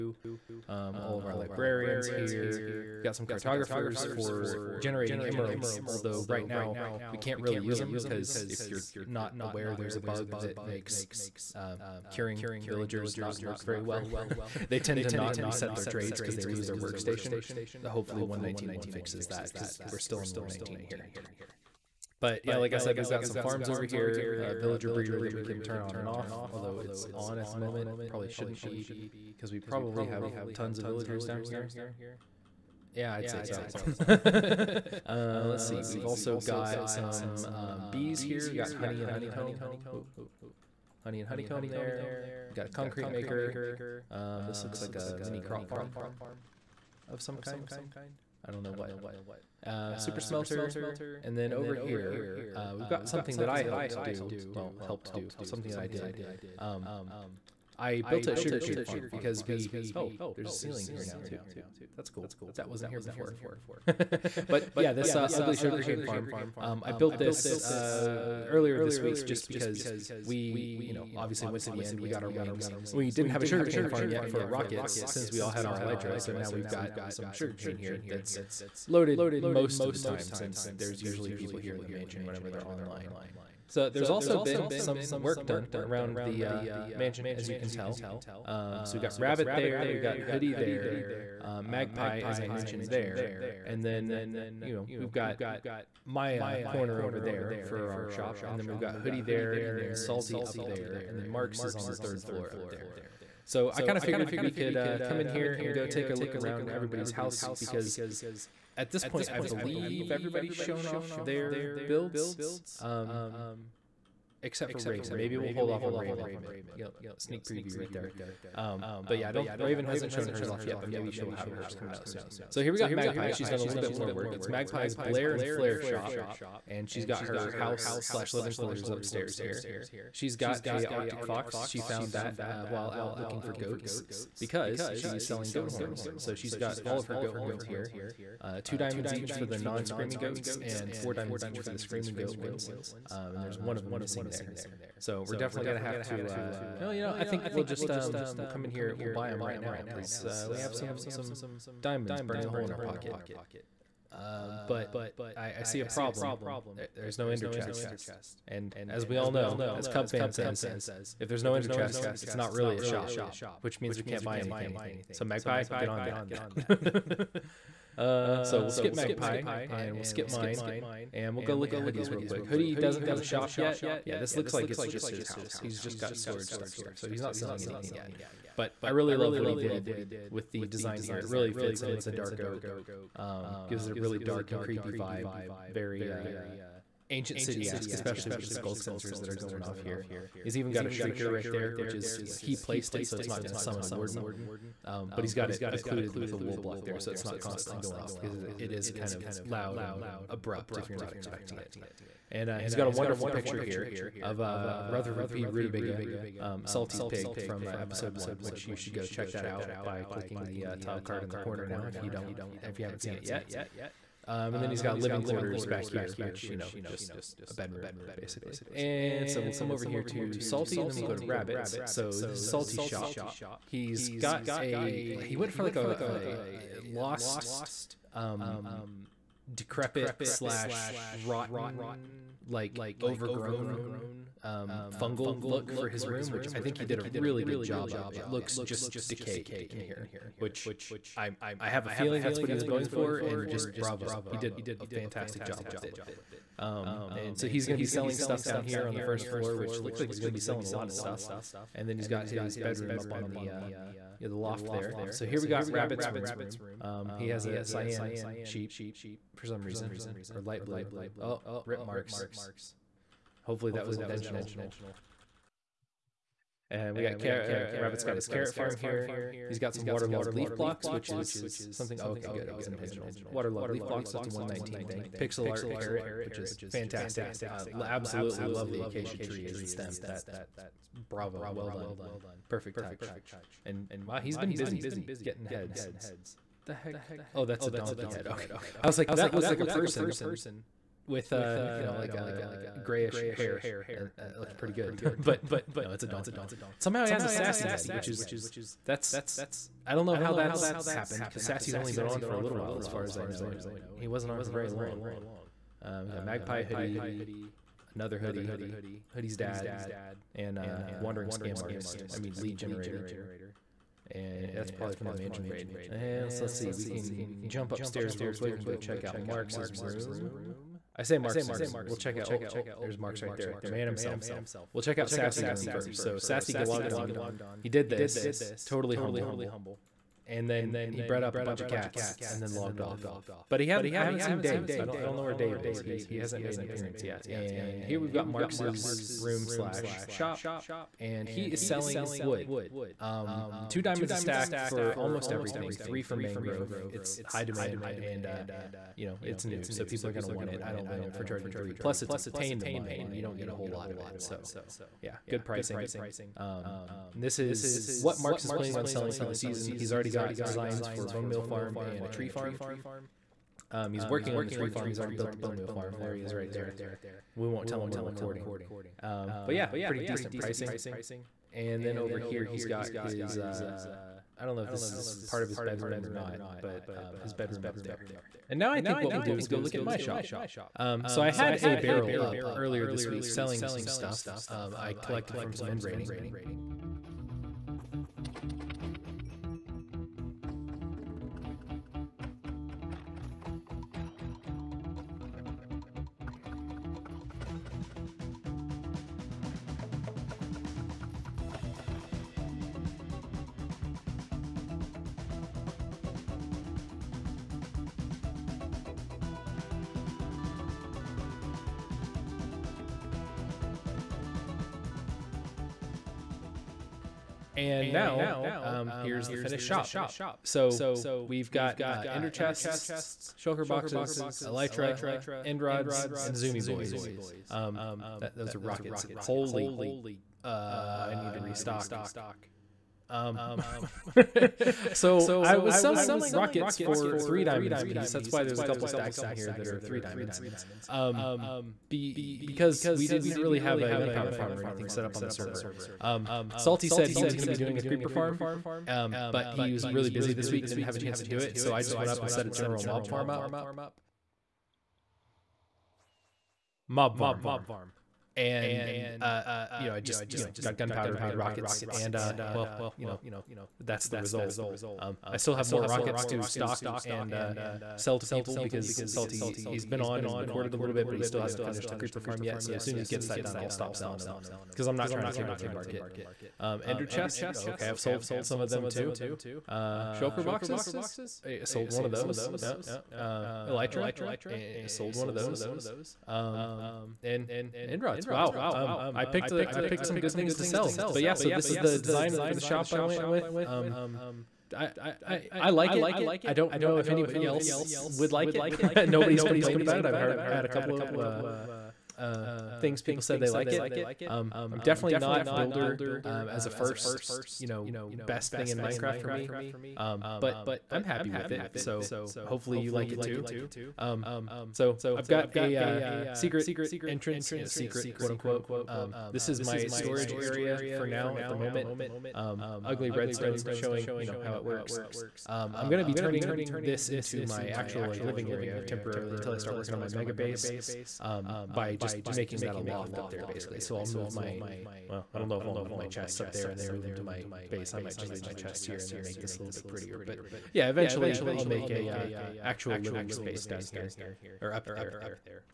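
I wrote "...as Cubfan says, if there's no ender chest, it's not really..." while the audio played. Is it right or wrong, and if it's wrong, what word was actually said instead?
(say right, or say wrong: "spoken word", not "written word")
right.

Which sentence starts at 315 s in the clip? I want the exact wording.
And so let's see, we can jump upstairs real quick and go check out Marx's room.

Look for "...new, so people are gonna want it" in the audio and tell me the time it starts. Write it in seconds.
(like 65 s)
349 s.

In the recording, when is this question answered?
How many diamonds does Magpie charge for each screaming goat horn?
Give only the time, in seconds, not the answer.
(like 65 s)
140 s.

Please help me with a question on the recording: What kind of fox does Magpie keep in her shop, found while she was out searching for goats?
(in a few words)
Arctic fox.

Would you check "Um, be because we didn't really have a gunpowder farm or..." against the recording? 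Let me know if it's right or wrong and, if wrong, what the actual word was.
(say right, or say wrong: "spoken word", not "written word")
right.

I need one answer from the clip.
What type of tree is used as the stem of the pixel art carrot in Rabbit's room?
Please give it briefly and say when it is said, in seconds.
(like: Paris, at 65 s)
Acacia, at 278 s.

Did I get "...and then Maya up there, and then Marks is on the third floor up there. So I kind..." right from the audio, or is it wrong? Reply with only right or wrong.
wrong.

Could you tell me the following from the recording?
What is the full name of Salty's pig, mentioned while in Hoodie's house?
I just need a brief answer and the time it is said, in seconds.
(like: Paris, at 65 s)
Rutherford P. Rutabaga, at 204 s.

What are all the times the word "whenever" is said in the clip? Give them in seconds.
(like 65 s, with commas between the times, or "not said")
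82 s.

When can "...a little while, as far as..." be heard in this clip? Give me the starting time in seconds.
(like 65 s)
302 s.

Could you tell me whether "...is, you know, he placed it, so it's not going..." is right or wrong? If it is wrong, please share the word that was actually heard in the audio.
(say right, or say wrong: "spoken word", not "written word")
right.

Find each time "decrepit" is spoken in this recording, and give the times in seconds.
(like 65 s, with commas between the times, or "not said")
229 s.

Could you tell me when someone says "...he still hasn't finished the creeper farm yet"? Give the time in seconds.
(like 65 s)
471 s.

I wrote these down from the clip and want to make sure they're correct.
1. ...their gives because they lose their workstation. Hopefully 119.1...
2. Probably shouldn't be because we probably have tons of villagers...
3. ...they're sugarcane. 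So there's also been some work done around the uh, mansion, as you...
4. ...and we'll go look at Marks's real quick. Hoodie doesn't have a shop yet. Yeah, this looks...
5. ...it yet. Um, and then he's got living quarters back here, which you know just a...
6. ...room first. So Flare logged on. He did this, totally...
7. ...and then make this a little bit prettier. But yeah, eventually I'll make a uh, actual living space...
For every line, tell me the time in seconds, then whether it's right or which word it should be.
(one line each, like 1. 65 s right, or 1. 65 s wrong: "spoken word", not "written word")
1. 15 s wrong: "trades", not "gives"
2. 28 s right
3. 82 s wrong: "online", not "sugarcane"
4. 171 s wrong: "Hoodie", not "Marks"
5. 213 s right
6. 325 s wrong: "Sassy", not "Flare"
7. 539 s right.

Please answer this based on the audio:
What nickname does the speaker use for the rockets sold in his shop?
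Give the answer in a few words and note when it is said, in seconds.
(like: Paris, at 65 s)
Zoomy boys, at 426 s.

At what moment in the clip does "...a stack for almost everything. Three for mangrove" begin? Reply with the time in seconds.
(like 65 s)
344 s.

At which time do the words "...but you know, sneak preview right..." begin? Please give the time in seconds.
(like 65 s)
116 s.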